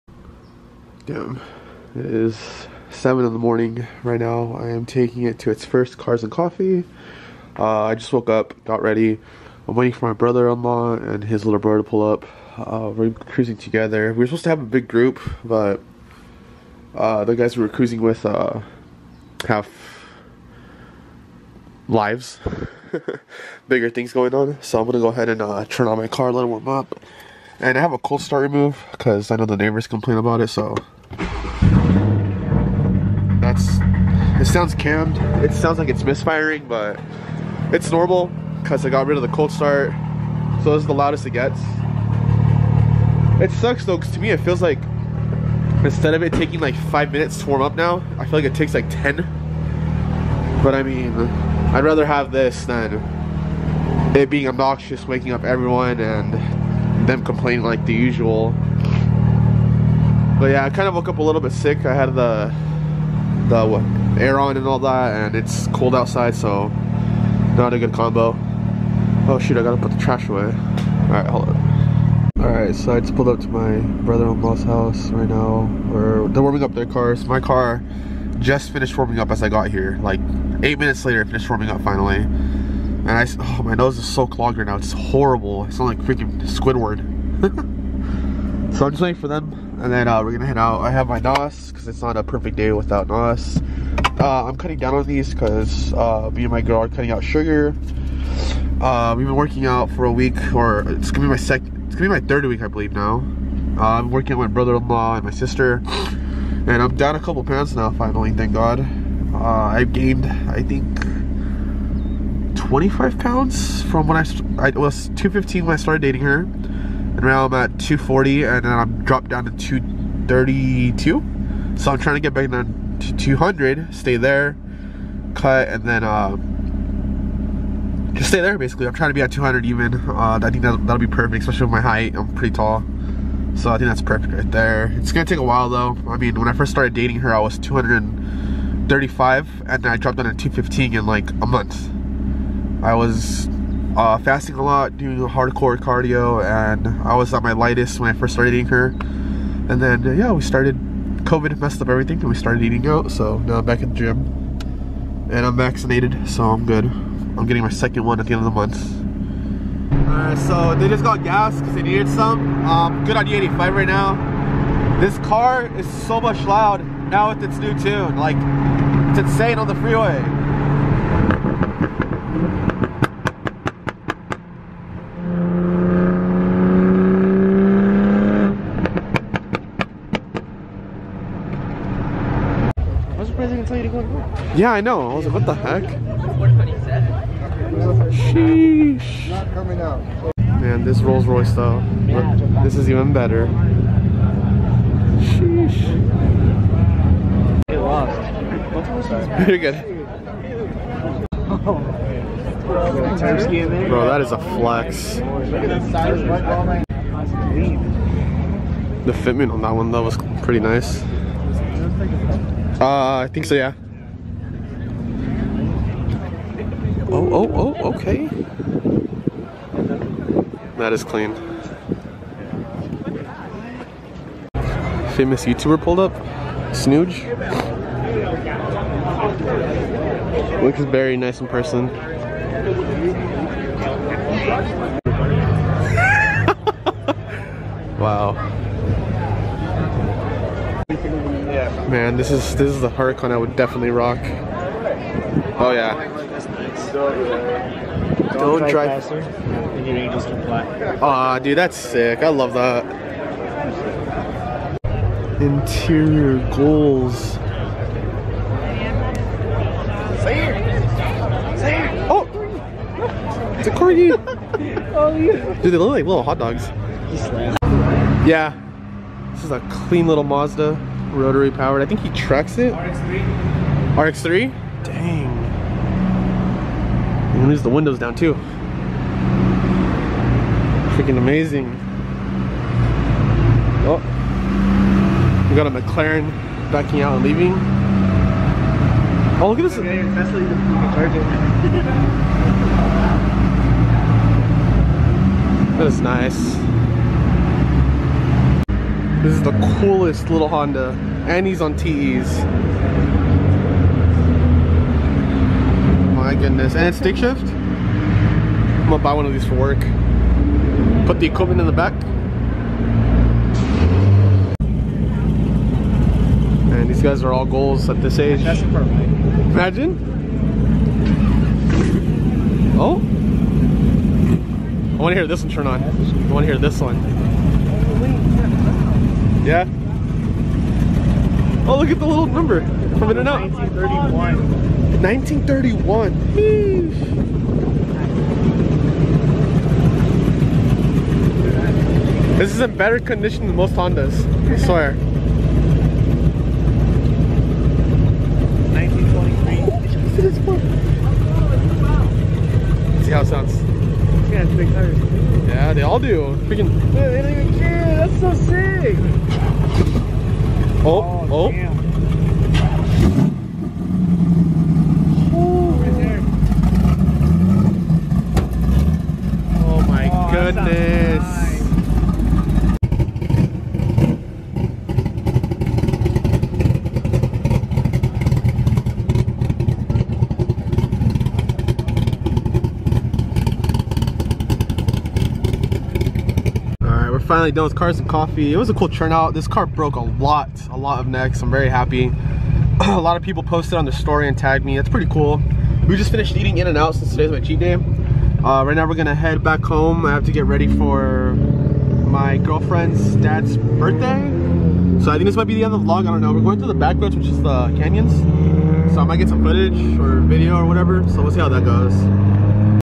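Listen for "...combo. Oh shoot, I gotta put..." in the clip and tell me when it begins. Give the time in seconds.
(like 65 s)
67 s.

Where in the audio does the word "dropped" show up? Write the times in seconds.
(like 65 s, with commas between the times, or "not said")
119 s, 139 s.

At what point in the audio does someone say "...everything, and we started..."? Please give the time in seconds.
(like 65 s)
151 s.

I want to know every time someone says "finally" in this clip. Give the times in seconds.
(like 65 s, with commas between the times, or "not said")
81 s, 107 s, 387 s.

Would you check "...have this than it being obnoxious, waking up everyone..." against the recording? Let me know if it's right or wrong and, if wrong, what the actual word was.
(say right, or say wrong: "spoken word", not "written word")
right.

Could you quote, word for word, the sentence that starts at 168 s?
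Like, it's insane on the freeway.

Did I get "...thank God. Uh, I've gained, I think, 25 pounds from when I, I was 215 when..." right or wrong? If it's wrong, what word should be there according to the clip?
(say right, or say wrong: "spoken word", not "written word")
right.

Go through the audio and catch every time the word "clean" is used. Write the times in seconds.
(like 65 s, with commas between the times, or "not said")
221 s, 269 s.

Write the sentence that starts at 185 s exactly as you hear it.
I was like, what the heck?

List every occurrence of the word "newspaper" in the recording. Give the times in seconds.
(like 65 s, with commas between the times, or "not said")
not said.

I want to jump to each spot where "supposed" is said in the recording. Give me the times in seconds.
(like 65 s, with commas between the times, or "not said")
14 s.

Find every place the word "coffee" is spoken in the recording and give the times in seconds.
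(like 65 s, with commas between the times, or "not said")
6 s, 388 s.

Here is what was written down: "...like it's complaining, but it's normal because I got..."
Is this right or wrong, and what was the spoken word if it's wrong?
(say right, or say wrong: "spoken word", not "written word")
wrong: "misfiring", not "complaining".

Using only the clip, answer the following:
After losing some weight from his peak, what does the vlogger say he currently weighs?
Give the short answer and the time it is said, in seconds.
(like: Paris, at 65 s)
232, at 119 s.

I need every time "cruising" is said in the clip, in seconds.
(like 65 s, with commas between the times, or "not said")
13 s, 17 s.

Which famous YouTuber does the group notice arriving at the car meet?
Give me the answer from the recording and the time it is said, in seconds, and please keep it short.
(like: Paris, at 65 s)
Snooge, at 226 s.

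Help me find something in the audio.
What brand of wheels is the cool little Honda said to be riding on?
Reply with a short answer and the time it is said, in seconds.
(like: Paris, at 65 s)
TEs, at 301 s.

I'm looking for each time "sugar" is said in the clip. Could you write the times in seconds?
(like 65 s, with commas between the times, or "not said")
97 s.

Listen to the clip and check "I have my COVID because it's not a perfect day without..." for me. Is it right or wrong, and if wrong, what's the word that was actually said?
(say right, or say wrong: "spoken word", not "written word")
wrong: "NOS", not "COVID".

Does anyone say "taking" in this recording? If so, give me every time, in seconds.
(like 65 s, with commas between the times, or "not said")
4 s, 46 s.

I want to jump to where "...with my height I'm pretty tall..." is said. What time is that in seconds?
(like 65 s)
131 s.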